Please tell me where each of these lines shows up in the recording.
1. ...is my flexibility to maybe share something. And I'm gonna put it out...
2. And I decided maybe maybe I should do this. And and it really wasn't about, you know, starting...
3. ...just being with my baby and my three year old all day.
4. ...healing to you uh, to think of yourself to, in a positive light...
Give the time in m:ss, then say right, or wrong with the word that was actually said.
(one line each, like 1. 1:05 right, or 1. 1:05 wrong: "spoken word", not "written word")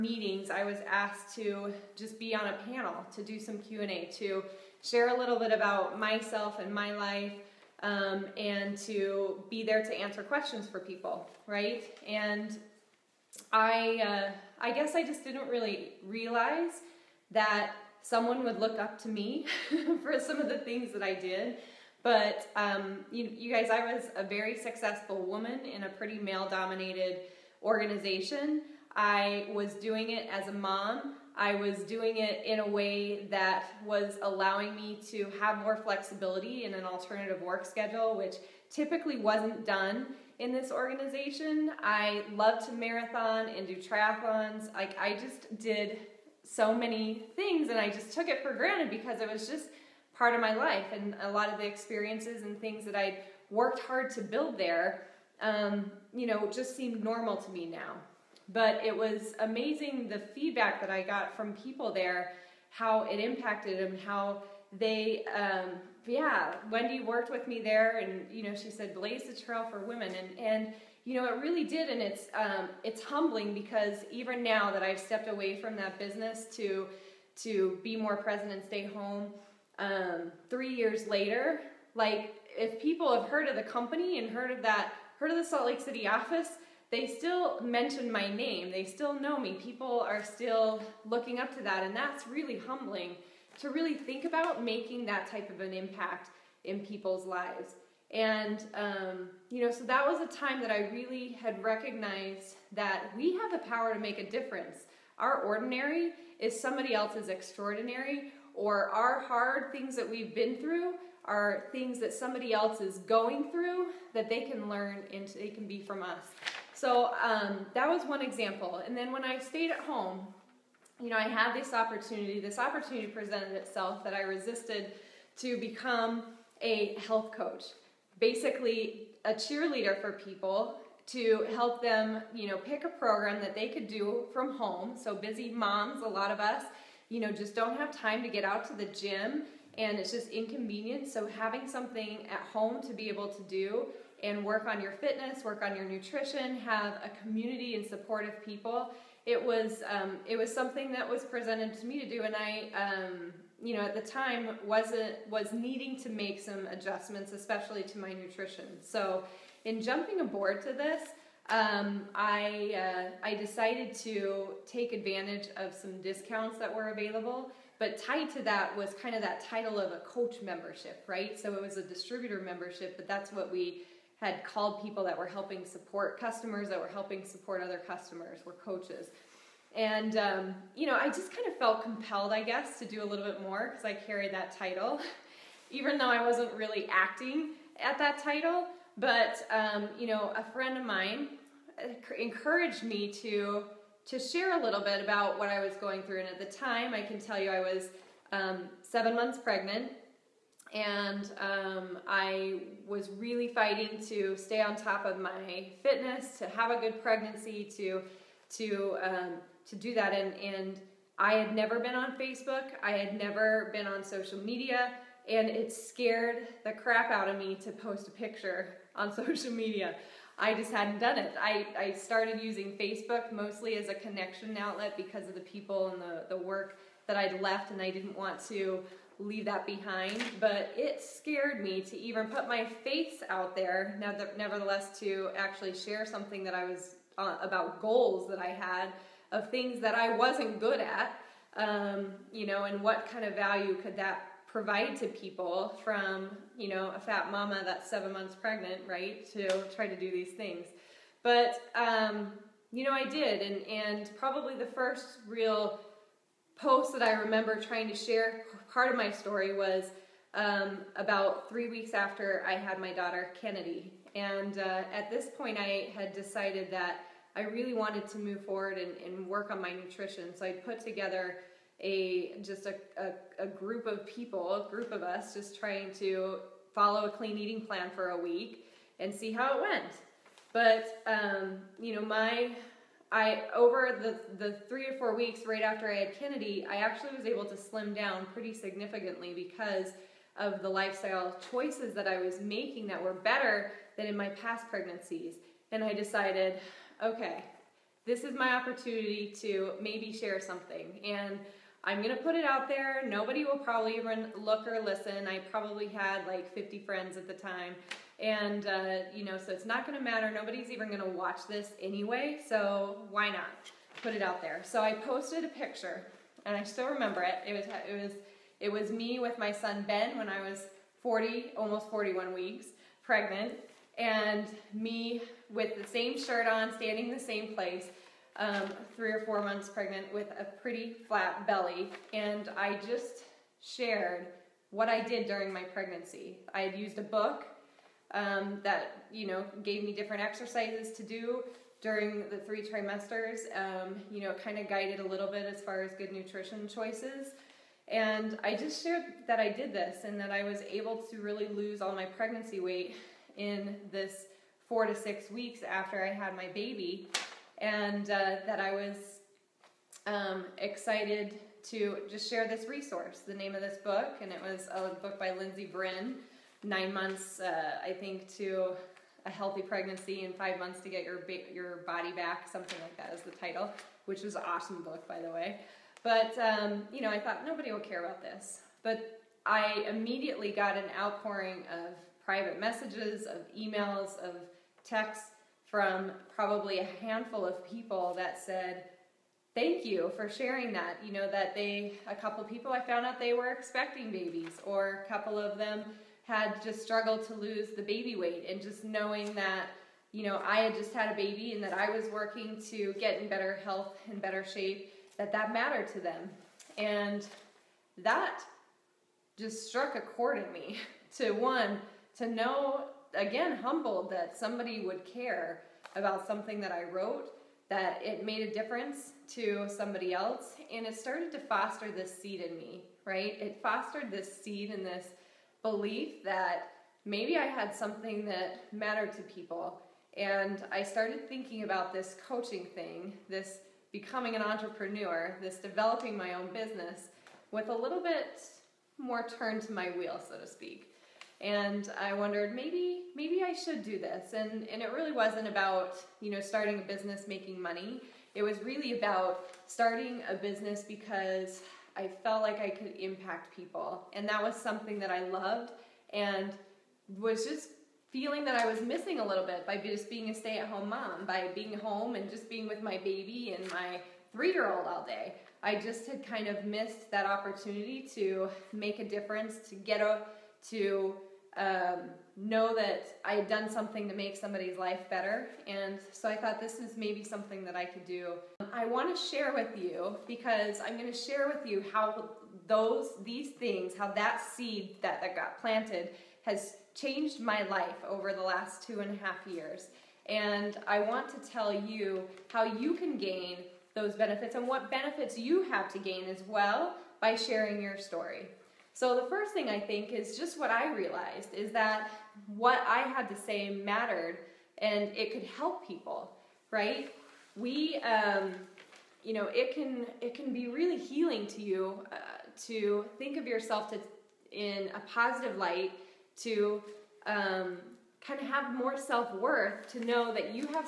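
1. 4:58 wrong: "opportunity", not "flexibility"
2. 7:21 wrong: "wondered", not "decided"
3. 7:42 right
4. 8:30 right.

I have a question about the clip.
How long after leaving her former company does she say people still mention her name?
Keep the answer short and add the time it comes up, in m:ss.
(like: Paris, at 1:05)
3 years, at 1:20.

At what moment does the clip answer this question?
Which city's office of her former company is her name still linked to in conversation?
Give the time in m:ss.
1:25.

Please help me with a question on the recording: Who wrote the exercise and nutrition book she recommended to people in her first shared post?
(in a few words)
Lindsay Brin.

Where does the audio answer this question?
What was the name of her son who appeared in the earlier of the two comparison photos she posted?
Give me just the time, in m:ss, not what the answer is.
5:19.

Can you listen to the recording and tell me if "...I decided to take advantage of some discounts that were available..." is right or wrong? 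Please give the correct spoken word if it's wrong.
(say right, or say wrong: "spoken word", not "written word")
right.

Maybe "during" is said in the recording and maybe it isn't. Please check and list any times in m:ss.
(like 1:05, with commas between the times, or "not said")
5:35, 5:41.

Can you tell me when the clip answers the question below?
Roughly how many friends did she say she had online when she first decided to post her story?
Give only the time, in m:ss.
5:06.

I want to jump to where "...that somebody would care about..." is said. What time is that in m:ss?
6:54.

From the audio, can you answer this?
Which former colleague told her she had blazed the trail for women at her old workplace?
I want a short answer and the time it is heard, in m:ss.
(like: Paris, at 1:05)
Wendy, at 1:06.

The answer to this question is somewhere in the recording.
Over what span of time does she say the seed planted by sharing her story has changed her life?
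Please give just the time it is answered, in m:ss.
8:08.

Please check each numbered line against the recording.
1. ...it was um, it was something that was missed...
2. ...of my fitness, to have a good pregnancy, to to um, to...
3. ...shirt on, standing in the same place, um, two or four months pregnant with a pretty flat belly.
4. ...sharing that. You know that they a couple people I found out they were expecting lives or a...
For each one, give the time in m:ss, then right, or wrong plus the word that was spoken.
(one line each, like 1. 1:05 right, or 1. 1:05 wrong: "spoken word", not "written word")
1. 2:29 wrong: "presented", not "missed"
2. 3:25 right
3. 5:26 wrong: "three", not "two"
4. 6:30 wrong: "babies", not "lives".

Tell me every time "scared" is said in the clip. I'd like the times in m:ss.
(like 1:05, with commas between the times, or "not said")
3:35, 3:51.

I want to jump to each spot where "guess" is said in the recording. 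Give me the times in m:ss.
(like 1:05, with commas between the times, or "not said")
0:14, 3:02.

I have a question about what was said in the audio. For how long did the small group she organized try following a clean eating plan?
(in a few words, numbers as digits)
A week.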